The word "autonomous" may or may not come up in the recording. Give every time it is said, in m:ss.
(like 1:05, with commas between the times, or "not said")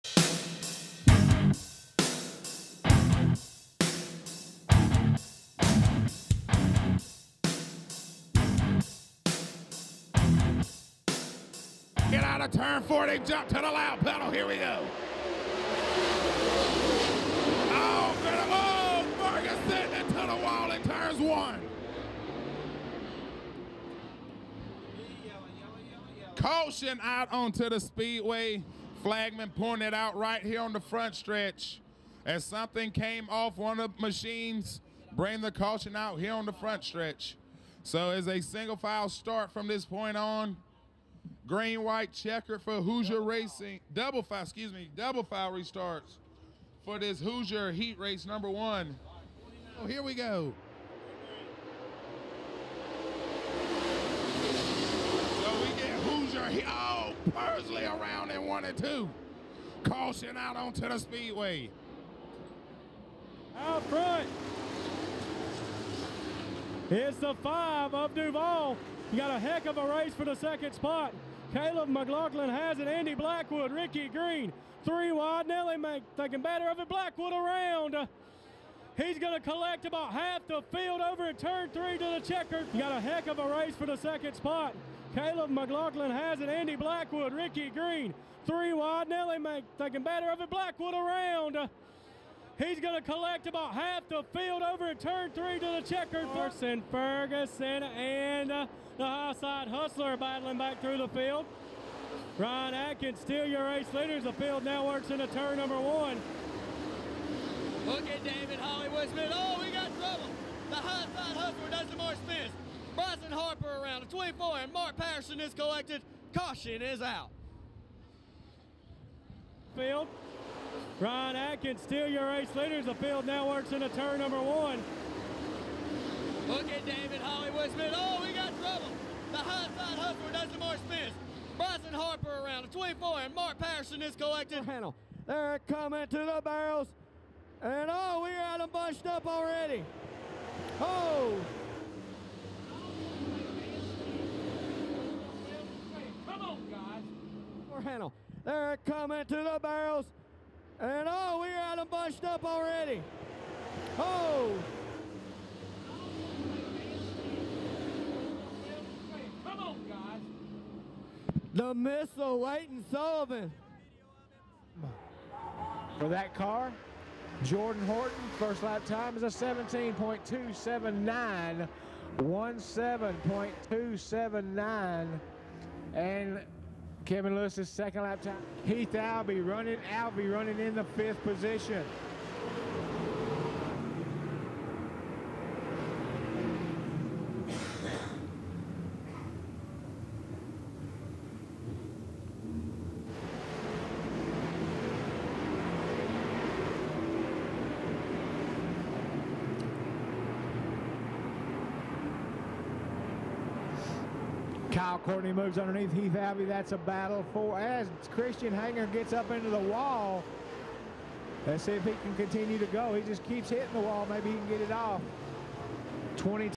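not said.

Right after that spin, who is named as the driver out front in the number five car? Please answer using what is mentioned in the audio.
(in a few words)
Duval.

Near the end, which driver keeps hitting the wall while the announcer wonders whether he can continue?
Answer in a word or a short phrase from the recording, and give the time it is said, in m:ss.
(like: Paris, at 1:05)
Christian Hanger, at 3:28.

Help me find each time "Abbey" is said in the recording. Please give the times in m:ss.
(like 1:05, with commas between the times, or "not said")
3:26.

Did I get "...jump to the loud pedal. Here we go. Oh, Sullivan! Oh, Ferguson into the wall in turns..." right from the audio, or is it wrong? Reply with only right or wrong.
wrong.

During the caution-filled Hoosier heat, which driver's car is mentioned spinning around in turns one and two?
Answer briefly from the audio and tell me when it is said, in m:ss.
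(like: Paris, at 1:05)
Pursley, at 0:57.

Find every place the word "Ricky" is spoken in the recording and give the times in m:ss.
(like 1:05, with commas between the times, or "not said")
1:13, 1:27.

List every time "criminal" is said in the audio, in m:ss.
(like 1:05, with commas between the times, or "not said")
not said.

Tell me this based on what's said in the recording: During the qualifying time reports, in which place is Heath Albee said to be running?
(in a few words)
fifth.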